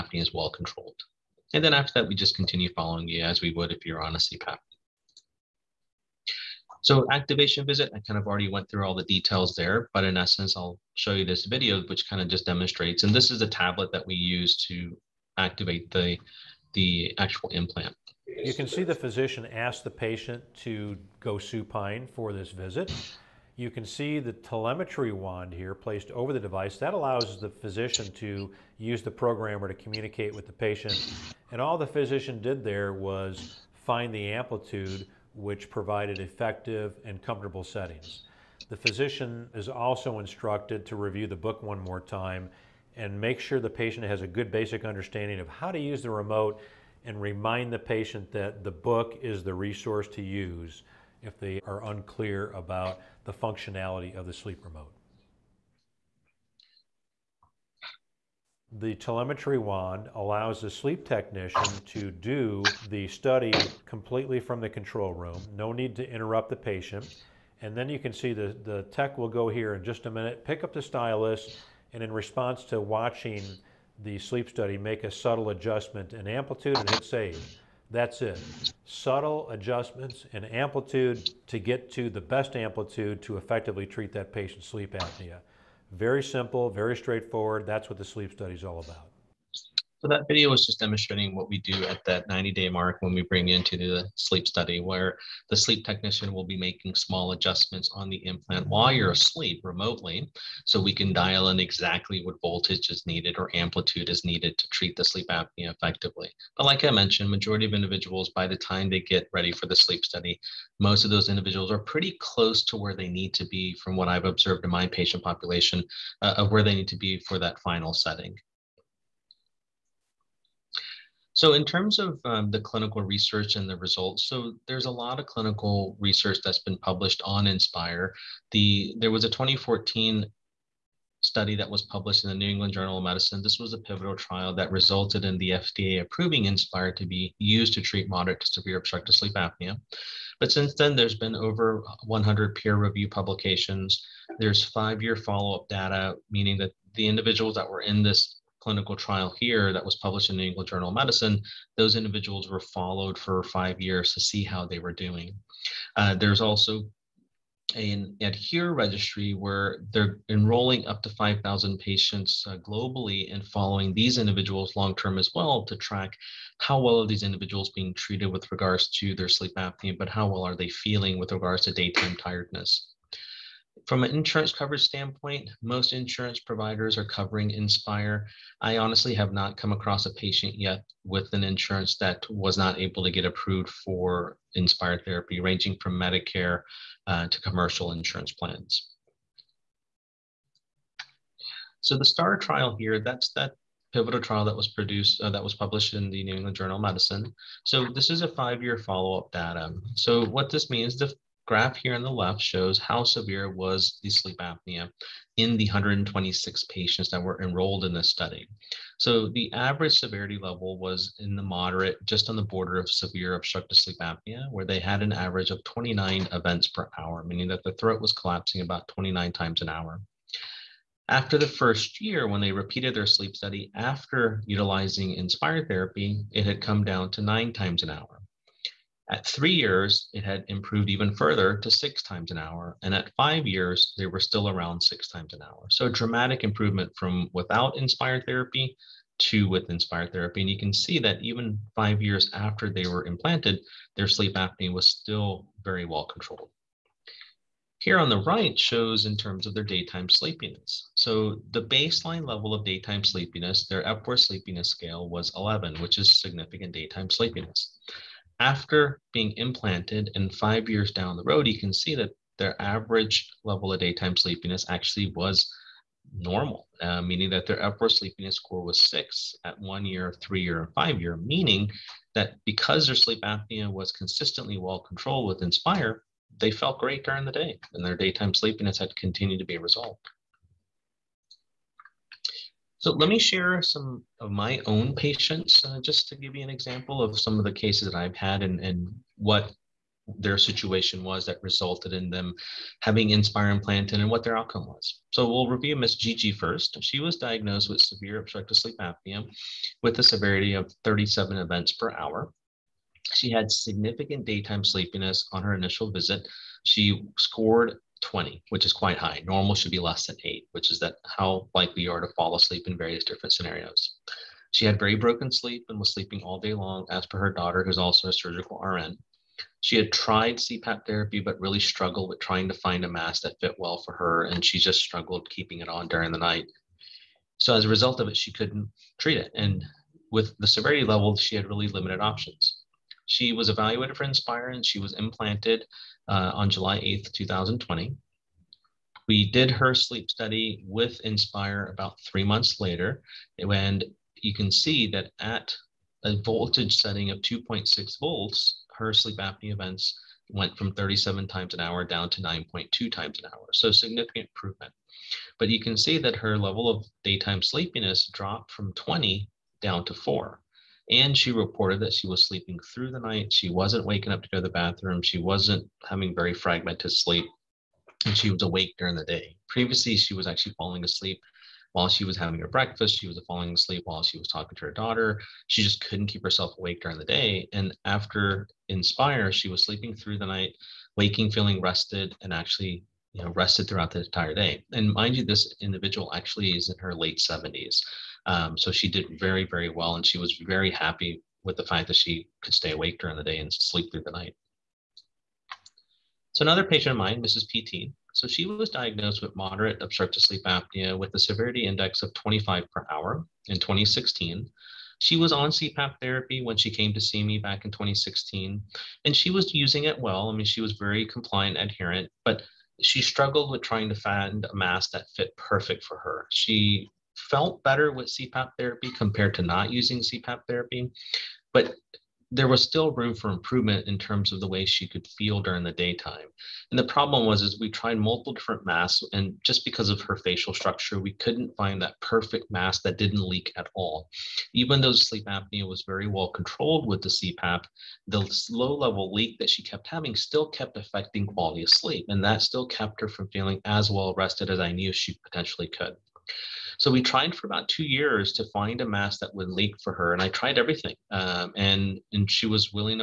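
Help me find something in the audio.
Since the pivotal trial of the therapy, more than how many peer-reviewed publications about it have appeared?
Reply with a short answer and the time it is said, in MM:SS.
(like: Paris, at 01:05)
100, at 02:22.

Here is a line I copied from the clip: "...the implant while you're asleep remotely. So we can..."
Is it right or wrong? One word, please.
right.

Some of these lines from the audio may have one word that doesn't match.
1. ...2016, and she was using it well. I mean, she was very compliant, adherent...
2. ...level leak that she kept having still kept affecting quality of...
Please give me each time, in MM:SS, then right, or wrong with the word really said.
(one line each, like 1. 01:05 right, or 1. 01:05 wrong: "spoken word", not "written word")
1. 06:47 right
2. 07:18 right.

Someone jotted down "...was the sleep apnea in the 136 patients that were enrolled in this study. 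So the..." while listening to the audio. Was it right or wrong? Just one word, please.
wrong.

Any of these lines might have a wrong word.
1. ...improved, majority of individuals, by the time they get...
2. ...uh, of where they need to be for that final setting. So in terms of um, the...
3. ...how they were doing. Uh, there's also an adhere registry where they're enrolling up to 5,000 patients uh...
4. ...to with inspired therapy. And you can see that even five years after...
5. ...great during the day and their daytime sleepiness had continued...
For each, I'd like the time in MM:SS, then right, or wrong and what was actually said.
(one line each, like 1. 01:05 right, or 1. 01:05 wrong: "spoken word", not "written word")
1. 01:46 wrong: "mentioned", not "improved"
2. 01:56 right
3. 02:34 right
4. 03:59 right
5. 04:36 right.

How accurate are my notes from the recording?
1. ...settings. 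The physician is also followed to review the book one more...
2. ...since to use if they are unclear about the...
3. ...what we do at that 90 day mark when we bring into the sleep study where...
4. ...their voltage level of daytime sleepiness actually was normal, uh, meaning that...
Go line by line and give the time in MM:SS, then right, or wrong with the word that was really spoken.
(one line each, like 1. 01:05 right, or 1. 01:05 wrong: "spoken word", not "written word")
1. 00:37 wrong: "instructed", not "followed"
2. 00:49 wrong: "resource", not "since"
3. 01:31 right
4. 04:22 wrong: "average", not "voltage".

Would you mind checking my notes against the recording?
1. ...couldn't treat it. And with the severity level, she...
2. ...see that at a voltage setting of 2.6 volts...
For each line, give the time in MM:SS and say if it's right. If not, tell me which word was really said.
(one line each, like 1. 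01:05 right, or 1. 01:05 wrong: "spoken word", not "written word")
1. 05:28 right
2. 05:44 right.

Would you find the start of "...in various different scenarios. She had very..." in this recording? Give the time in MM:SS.
05:12.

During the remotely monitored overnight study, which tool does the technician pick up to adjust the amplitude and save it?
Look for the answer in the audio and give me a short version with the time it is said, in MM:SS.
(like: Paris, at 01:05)
stylus, at 01:10.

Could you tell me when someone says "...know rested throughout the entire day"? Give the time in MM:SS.
06:23.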